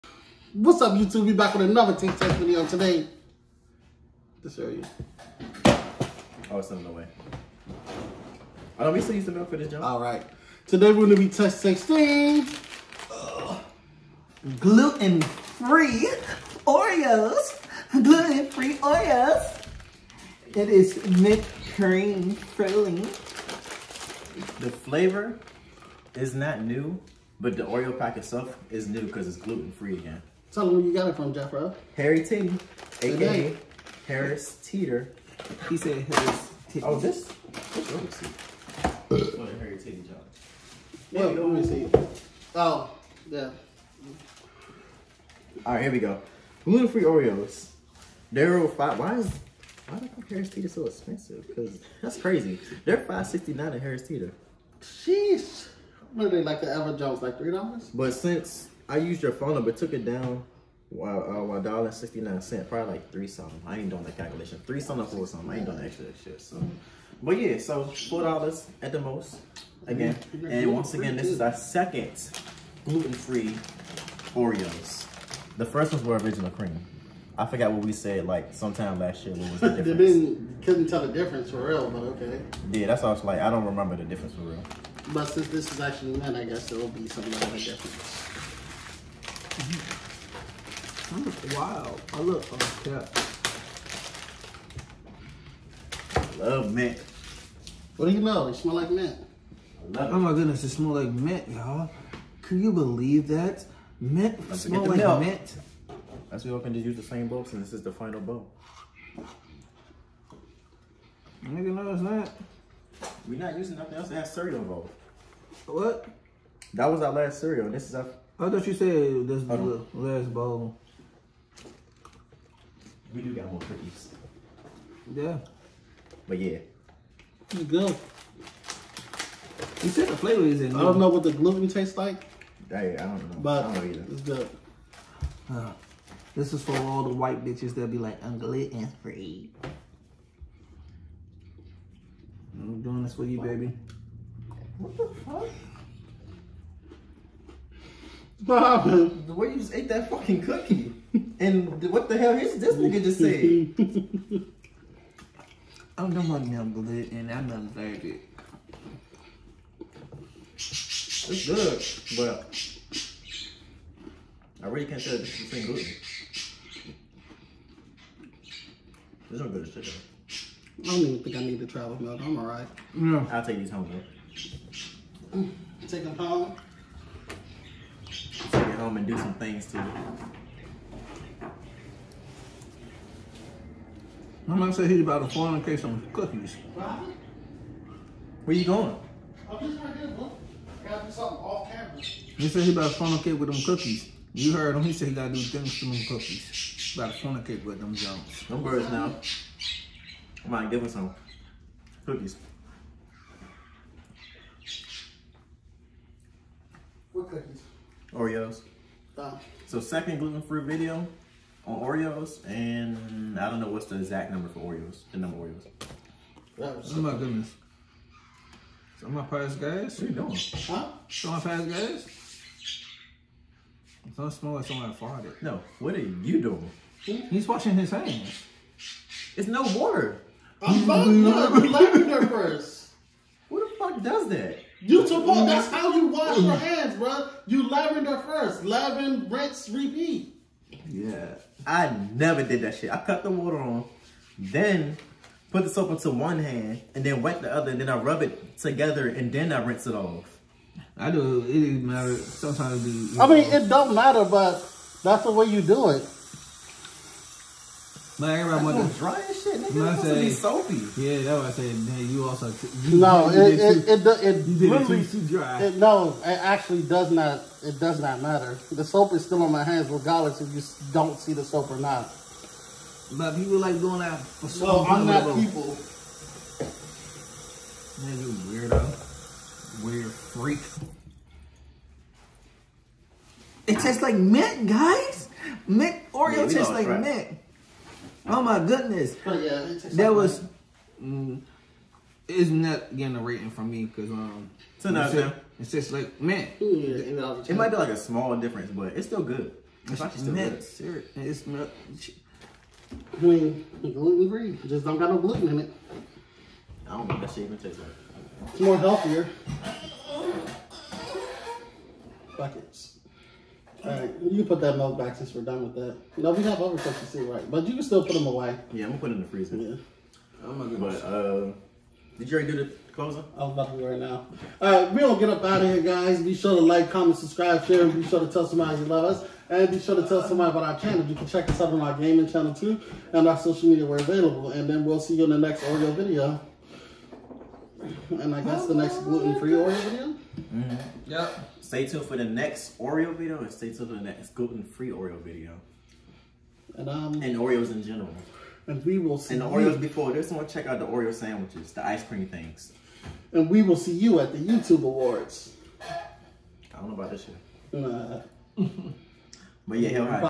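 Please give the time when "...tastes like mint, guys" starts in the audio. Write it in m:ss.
4:43.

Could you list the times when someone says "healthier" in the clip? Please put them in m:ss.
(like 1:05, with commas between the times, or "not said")
5:08.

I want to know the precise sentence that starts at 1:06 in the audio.
So, but yeah, so four dollars at the most.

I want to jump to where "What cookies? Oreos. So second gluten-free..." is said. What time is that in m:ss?
3:27.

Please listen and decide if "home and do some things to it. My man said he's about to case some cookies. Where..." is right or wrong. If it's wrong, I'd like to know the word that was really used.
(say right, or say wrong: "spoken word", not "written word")
right.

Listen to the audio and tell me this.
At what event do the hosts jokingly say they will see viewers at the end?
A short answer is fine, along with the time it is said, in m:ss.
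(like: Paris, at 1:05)
YouTube Awards, at 5:54.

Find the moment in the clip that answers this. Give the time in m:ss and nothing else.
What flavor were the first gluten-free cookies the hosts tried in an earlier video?
1:16.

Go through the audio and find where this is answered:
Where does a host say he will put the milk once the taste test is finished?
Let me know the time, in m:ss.
5:19.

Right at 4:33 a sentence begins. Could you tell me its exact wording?
But people like going out for Well, I'm not people.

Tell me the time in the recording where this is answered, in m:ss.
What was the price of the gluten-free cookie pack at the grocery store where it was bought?
0:52.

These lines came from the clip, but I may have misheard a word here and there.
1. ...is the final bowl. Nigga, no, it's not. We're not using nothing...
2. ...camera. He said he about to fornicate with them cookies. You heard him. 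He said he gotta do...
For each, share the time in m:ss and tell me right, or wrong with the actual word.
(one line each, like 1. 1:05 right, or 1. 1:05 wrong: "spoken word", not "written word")
1. 1:47 right
2. 3:11 right.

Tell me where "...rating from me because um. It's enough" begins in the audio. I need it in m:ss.
4:53.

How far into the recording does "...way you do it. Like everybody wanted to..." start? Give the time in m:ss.
4:15.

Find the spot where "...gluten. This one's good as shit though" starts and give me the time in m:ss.
2:45.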